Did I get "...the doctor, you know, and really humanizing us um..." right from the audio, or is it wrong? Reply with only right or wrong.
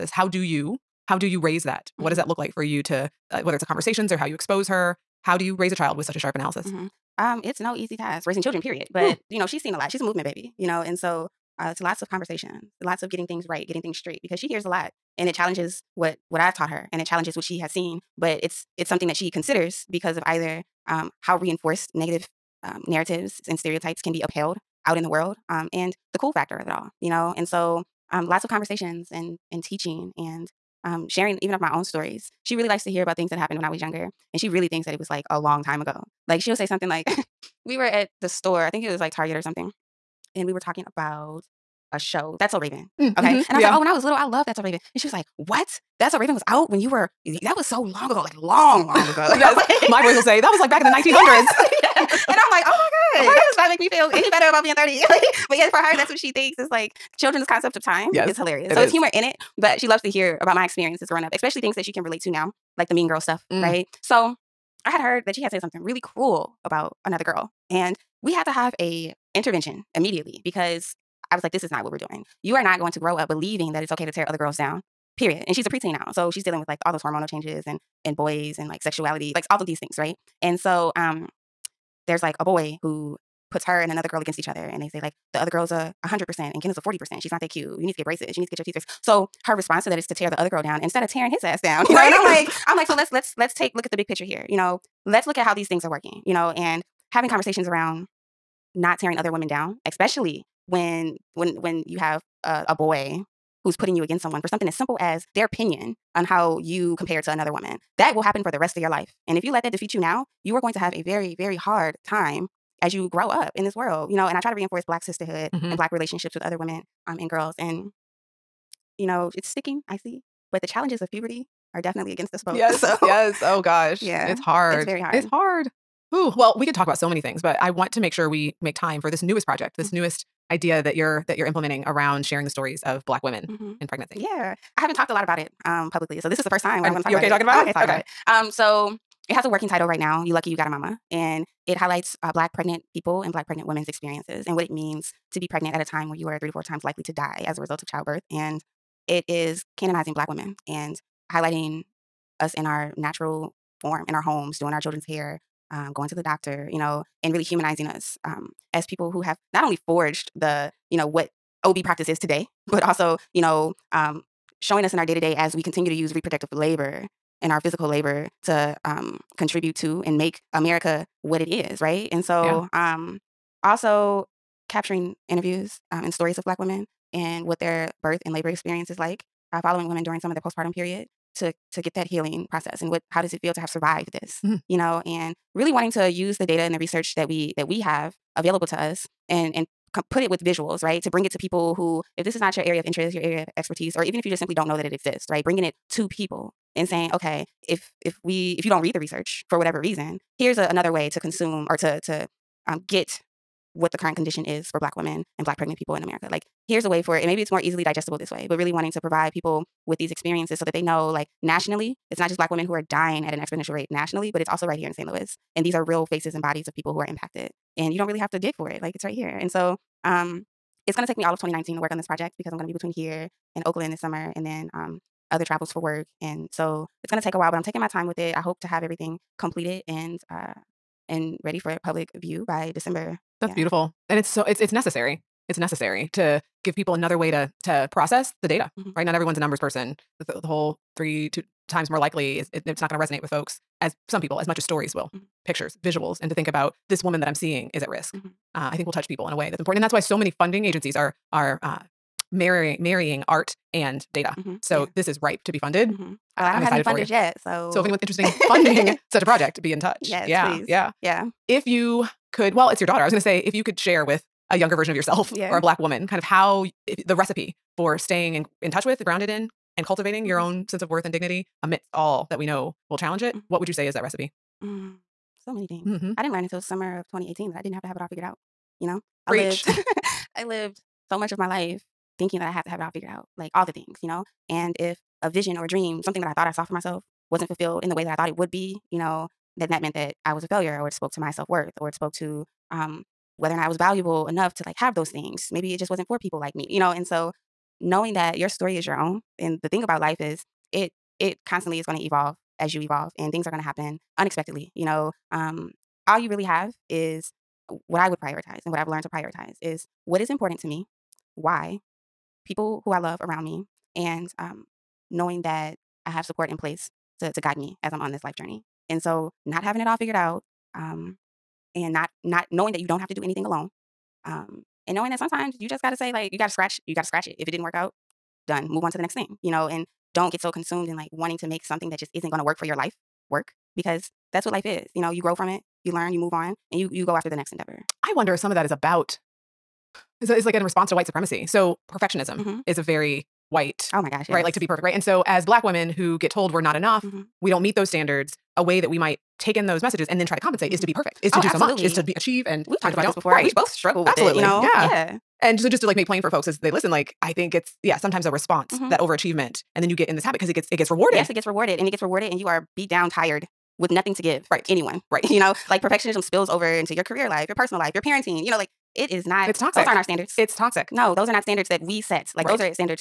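right.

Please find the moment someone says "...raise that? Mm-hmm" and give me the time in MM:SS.
00:01.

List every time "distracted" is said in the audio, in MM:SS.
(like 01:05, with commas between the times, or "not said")
not said.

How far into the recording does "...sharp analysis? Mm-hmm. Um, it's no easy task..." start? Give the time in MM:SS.
00:06.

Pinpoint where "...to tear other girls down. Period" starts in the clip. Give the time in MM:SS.
01:14.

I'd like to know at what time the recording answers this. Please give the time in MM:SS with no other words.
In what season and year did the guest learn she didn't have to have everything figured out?
04:36.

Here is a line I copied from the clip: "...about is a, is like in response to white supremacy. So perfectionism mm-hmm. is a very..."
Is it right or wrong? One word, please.
right.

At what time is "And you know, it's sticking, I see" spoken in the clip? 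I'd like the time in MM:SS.
01:57.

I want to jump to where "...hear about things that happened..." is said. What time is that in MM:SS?
00:32.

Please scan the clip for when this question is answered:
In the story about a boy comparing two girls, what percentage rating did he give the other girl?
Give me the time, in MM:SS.
01:26.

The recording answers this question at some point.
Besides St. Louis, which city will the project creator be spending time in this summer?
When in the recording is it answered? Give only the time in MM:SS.
03:43.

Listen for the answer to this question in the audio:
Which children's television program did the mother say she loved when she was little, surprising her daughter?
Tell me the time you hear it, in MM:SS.
00:42.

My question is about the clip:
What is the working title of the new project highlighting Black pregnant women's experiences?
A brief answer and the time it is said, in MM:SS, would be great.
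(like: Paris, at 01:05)
You lucky you got a mama, at 02:20.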